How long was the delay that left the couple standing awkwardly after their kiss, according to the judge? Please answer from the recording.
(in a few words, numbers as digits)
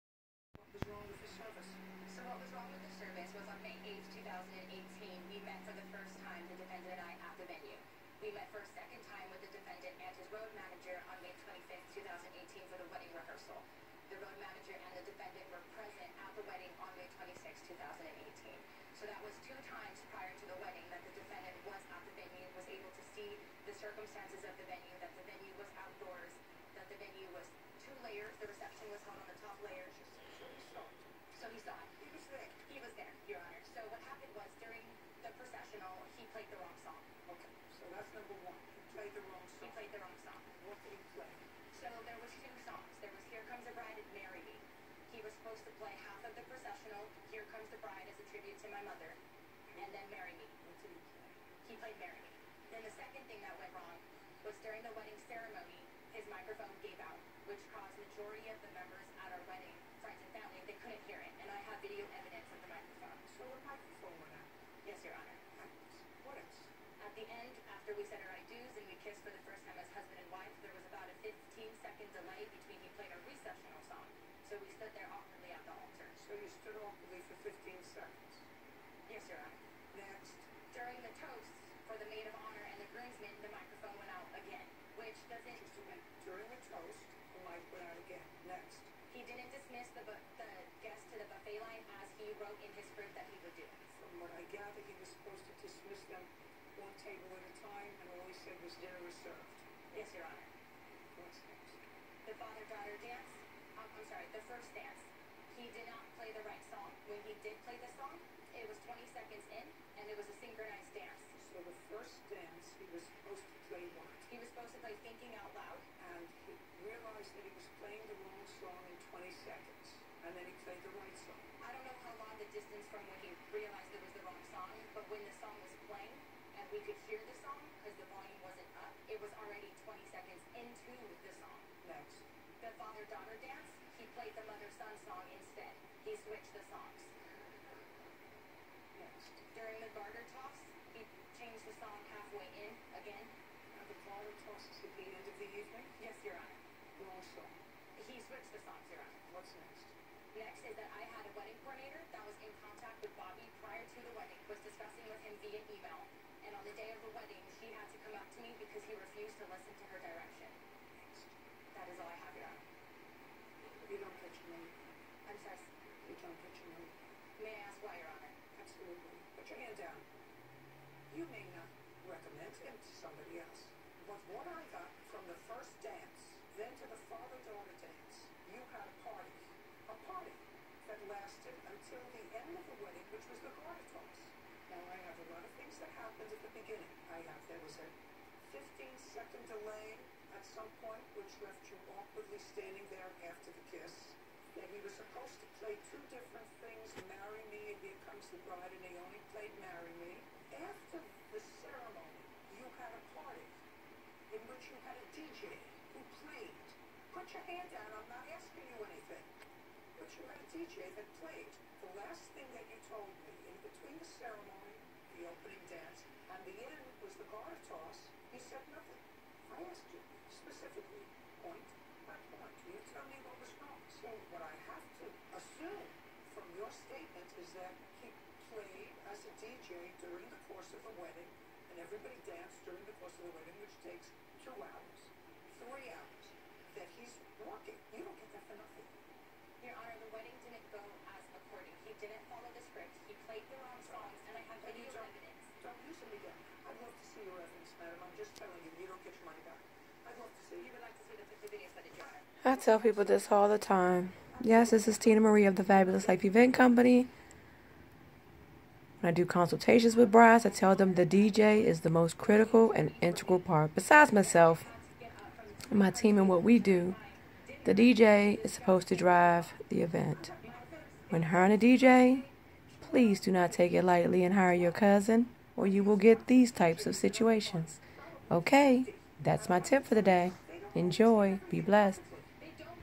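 15 seconds.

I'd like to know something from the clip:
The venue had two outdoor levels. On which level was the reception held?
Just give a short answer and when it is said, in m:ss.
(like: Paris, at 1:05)
Top layer, at 0:29.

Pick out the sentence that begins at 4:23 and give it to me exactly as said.
Besides myself, my team, and what we do, the DJ is supposed to drive the event.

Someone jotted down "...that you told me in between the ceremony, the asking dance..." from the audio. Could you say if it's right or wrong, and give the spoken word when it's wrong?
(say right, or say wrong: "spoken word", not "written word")
wrong: "opening", not "asking".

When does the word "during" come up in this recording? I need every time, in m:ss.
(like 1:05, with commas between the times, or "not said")
0:54, 1:25, 2:19, 3:52.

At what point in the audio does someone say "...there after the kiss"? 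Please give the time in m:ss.
3:12.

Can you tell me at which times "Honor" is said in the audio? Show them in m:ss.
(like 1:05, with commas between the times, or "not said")
1:40, 3:59.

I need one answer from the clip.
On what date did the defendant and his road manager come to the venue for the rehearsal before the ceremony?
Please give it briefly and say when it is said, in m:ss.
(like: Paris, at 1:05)
May 25, 2018, at 0:11.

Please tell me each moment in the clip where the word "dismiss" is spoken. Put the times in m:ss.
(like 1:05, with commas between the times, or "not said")
1:29, 1:35.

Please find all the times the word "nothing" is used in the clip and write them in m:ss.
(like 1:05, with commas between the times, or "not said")
3:38, 3:58.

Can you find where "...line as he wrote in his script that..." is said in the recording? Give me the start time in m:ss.
1:31.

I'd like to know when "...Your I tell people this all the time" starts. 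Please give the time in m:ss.
4:11.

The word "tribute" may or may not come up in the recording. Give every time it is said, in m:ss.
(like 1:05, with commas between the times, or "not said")
0:48.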